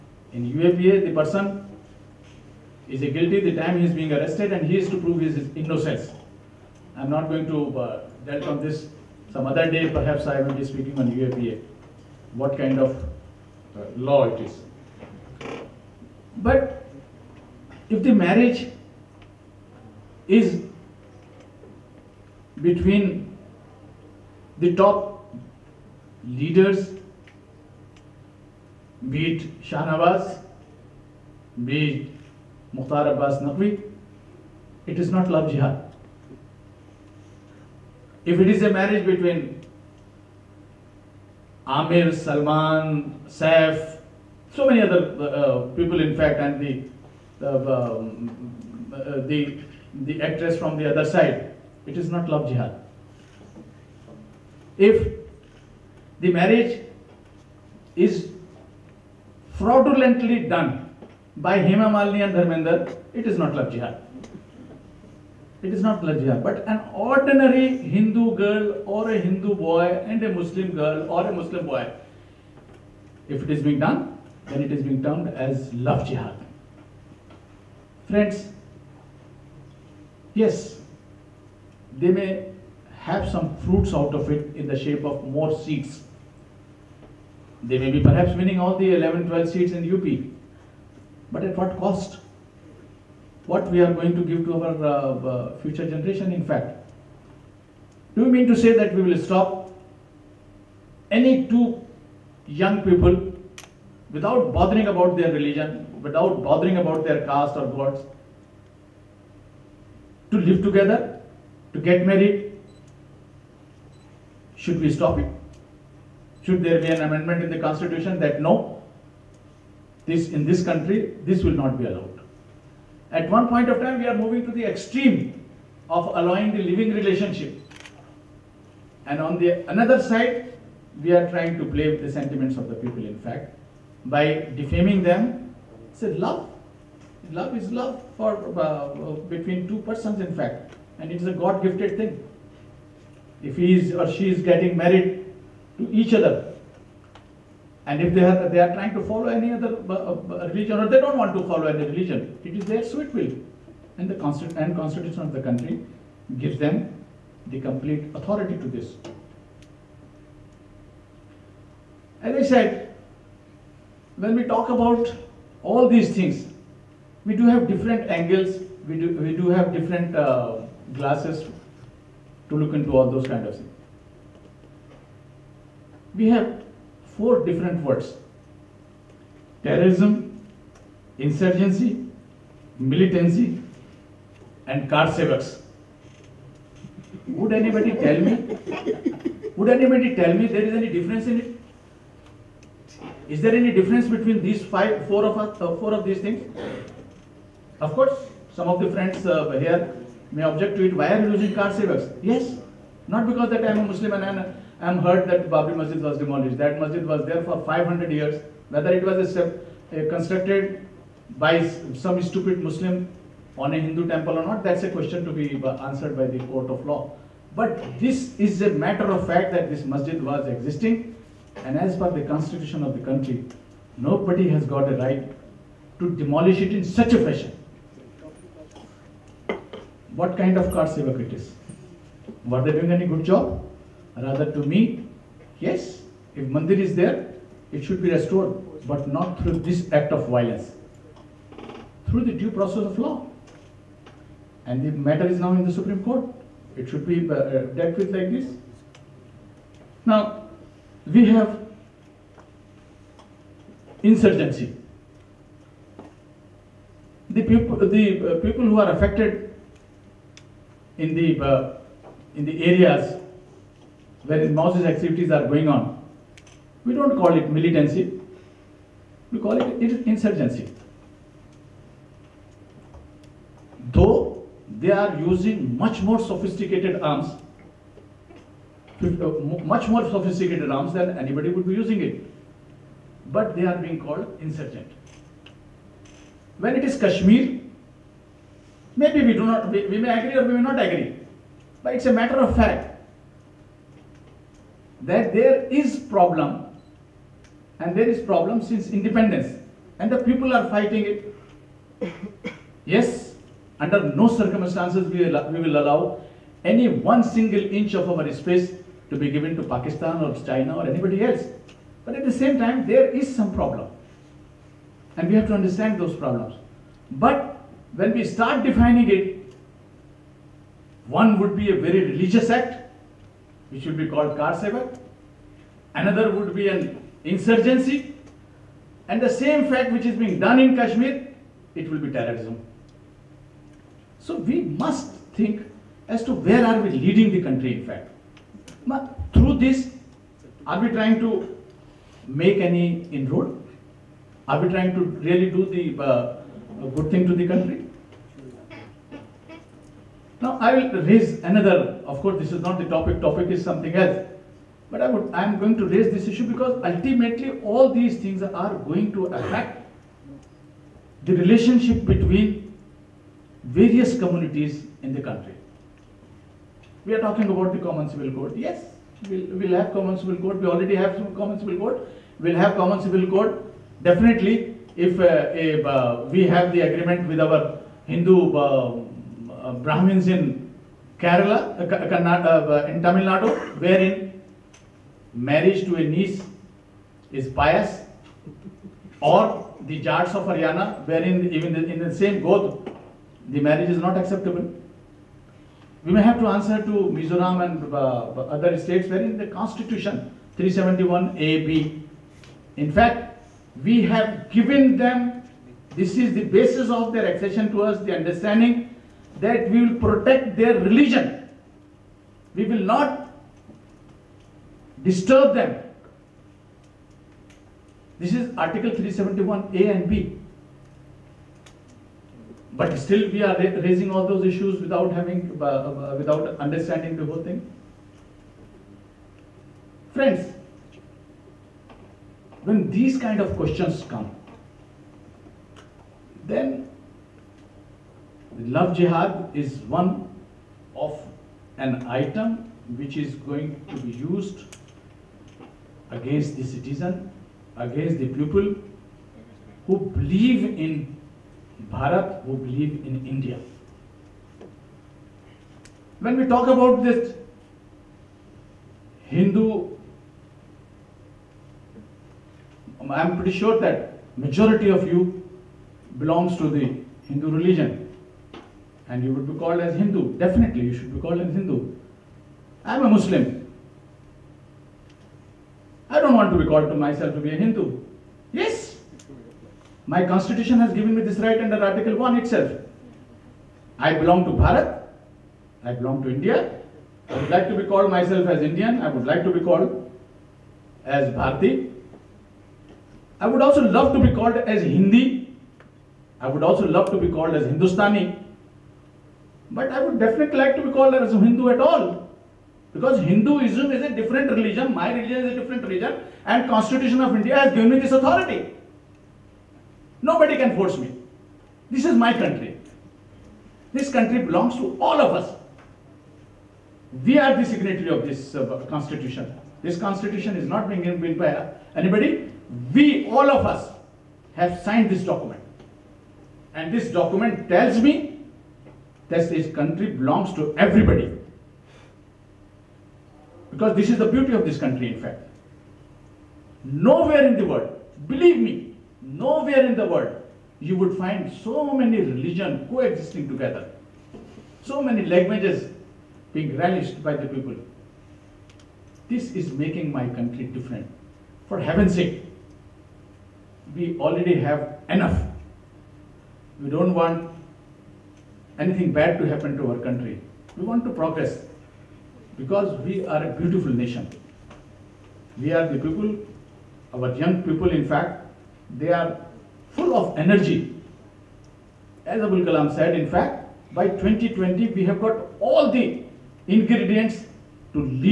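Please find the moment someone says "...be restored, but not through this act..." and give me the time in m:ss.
3:58.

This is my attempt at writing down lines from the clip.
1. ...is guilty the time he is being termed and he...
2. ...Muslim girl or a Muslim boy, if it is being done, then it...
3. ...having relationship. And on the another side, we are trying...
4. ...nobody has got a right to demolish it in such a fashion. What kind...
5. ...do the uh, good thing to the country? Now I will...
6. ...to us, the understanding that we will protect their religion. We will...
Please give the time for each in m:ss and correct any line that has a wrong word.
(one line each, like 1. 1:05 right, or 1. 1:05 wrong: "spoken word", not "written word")
1. 0:02 wrong: "arrested", not "termed"
2. 1:10 right
3. 2:06 wrong: "living", not "having"
4. 3:43 right
5. 5:45 right
6. 6:47 right.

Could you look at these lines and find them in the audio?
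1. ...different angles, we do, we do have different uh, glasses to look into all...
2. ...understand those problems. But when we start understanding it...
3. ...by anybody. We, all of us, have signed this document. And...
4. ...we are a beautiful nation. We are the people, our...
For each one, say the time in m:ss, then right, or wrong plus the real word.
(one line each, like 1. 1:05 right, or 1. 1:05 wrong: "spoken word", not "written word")
1. 2:47 right
2. 5:15 wrong: "defining", not "understanding"
3. 8:41 right
4. 9:23 right.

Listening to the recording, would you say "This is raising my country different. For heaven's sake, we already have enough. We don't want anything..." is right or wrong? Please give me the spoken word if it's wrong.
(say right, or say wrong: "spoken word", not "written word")
wrong: "making", not "raising".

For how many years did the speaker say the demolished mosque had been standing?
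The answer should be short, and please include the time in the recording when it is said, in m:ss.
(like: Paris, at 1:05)
500, at 3:27.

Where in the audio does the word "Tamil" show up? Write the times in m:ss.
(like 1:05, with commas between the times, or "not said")
6:23.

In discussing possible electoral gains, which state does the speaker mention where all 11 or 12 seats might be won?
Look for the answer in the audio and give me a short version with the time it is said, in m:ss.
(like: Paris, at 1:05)
UP, at 1:29.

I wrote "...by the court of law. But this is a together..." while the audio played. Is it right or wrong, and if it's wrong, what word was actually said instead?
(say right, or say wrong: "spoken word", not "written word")
wrong: "matter", not "together".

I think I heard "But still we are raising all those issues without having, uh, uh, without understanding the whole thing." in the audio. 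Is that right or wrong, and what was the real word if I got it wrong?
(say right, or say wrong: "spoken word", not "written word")
right.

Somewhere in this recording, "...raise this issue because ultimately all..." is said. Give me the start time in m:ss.
5:55.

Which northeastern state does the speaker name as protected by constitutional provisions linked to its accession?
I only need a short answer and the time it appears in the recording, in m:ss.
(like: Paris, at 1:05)
Mizoram, at 6:37.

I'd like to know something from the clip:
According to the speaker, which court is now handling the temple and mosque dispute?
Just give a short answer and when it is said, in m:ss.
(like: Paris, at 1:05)
Supreme Court, at 4:05.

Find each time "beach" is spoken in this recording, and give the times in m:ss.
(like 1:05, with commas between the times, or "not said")
not said.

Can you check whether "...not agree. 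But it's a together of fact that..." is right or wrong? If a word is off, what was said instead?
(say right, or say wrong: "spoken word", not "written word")
wrong: "matter", not "together".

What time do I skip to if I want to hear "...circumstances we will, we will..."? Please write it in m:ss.
5:04.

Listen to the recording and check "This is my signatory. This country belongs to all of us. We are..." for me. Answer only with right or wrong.
wrong.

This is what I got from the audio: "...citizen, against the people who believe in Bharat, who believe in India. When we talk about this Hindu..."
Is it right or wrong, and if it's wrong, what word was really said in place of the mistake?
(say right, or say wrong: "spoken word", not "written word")
right.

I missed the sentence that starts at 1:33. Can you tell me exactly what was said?
what we are going to give to our uh, future generation.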